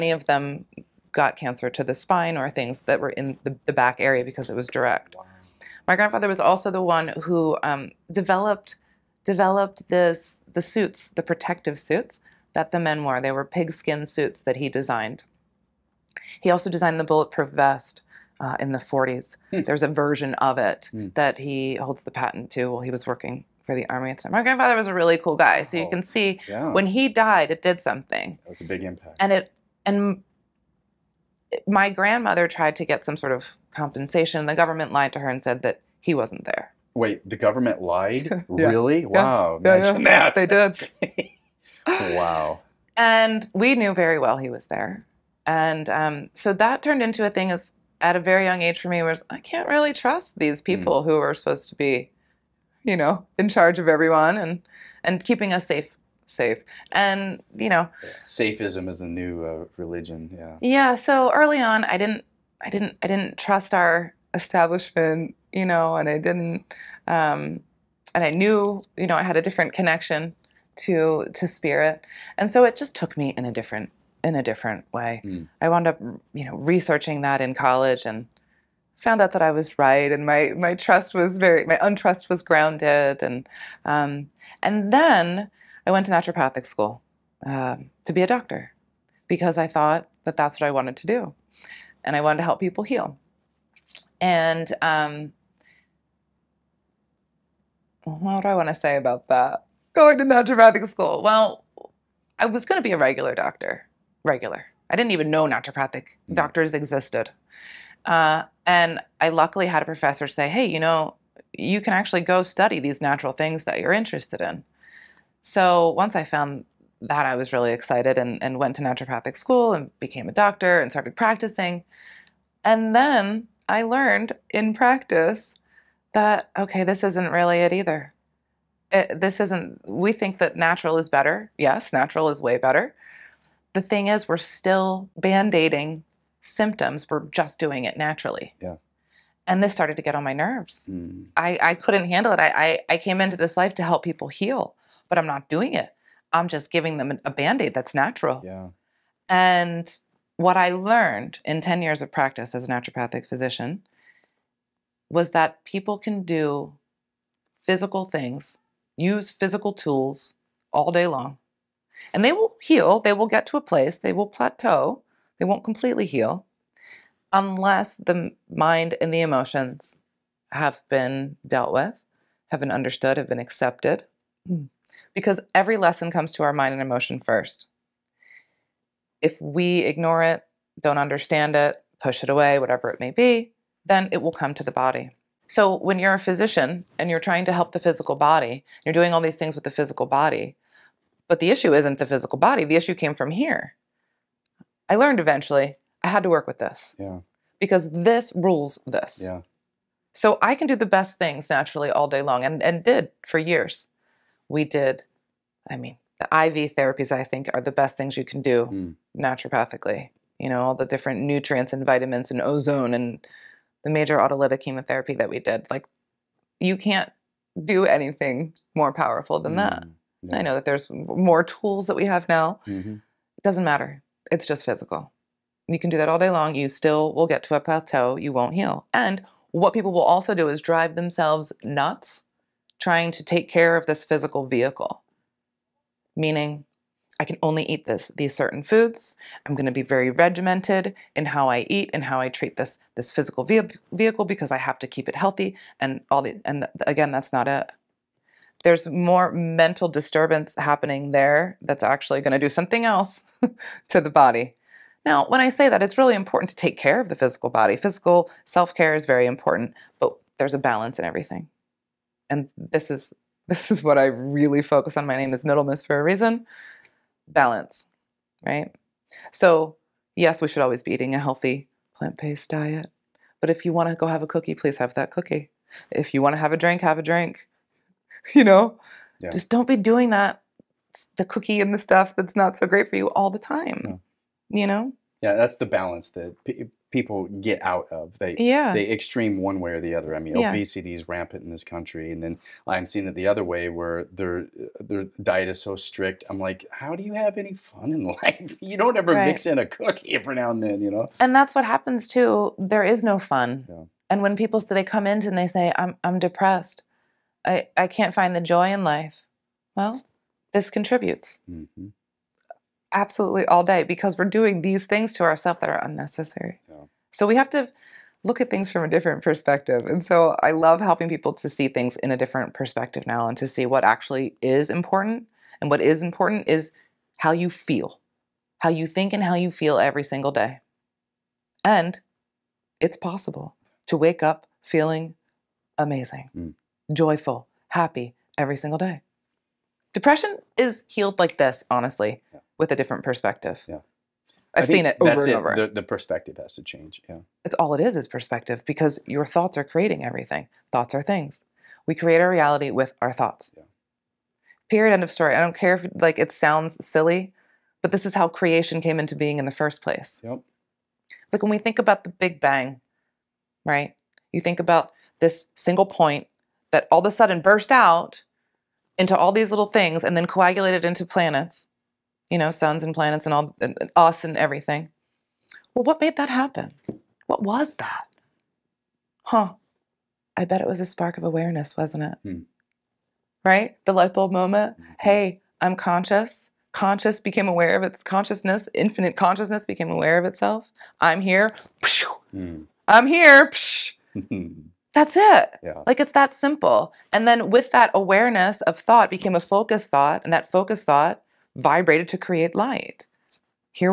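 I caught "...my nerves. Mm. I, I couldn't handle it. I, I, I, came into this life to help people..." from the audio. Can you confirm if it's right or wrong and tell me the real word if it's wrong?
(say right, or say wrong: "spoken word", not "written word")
right.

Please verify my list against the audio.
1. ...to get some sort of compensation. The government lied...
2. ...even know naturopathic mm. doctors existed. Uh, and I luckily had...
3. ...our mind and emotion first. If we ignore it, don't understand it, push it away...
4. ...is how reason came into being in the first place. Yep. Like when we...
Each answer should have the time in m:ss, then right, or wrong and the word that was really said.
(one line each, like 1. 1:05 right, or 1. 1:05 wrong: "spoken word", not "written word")
1. 0:32 right
2. 1:45 right
3. 2:56 right
4. 5:58 wrong: "creation", not "reason".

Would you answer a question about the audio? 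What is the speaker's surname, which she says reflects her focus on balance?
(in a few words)
Middlemiss.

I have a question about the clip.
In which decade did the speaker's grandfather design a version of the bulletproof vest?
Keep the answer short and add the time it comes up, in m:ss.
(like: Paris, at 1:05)
40s, at 0:18.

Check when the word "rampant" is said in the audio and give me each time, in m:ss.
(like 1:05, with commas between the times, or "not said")
4:51.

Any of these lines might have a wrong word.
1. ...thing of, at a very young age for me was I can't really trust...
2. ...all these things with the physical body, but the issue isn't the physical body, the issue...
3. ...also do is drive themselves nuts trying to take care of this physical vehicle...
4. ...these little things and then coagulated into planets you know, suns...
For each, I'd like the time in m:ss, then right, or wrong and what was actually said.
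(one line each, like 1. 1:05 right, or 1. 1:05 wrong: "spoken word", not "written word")
1. 0:47 right
2. 3:09 right
3. 3:50 right
4. 6:09 right.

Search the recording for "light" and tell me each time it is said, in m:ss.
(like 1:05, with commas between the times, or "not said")
6:23, 6:42.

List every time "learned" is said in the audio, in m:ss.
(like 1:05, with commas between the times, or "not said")
2:03, 2:30, 3:14.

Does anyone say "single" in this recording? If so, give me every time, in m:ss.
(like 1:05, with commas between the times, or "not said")
5:30, 5:38, 6:05.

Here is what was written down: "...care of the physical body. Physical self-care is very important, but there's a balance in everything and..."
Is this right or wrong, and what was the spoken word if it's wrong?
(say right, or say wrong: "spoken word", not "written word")
right.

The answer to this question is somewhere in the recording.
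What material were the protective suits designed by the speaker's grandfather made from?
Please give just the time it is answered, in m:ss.
0:13.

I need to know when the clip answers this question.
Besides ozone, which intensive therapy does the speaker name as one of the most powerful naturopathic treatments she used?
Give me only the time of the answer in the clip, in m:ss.
3:33.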